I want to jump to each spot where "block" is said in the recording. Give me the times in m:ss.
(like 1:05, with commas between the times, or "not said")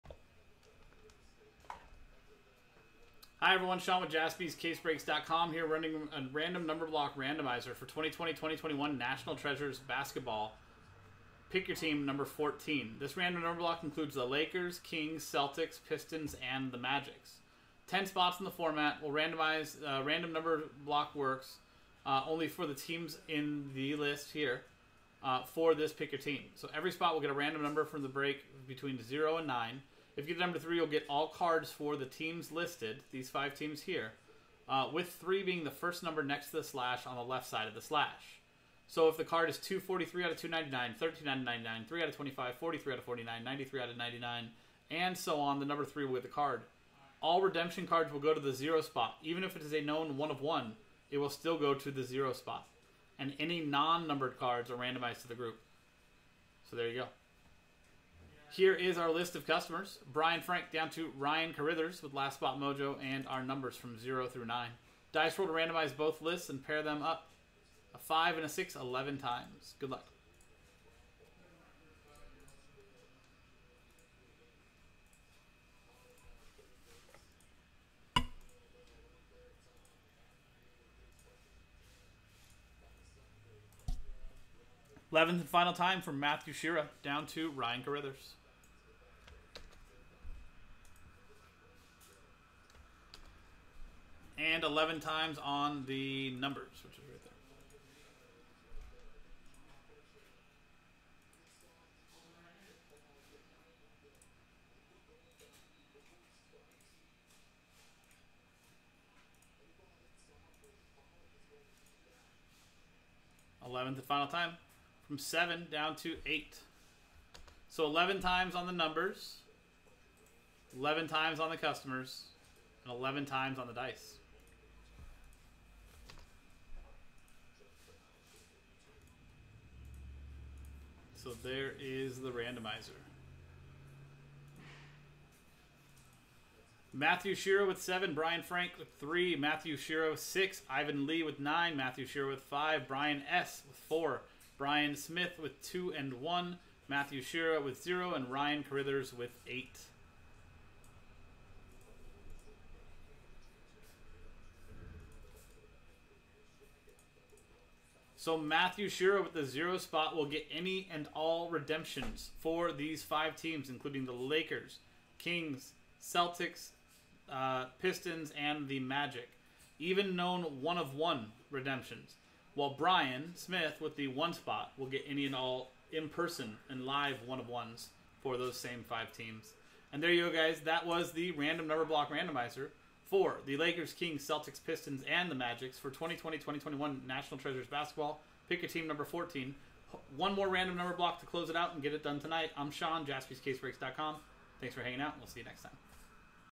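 0:06, 0:13, 0:20, 3:01, 3:10.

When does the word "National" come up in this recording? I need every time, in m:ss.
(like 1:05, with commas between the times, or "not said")
0:08, 3:07.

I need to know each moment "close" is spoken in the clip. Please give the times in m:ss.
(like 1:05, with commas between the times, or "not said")
3:11.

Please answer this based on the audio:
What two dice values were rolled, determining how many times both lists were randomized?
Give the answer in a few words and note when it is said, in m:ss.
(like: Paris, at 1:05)
5 and 6, at 1:07.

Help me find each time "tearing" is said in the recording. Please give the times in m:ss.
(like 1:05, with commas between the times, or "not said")
not said.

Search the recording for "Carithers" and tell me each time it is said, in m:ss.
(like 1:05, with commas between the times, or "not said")
1:01, 2:28.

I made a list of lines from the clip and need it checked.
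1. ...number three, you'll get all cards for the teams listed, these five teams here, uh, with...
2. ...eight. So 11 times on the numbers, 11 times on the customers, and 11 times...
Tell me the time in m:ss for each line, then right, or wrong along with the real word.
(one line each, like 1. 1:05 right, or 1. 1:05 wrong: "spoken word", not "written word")
1. 0:30 right
2. 1:56 right.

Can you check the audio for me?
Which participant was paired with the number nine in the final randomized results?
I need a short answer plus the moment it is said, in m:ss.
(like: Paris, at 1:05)
Ivan Lee, at 2:20.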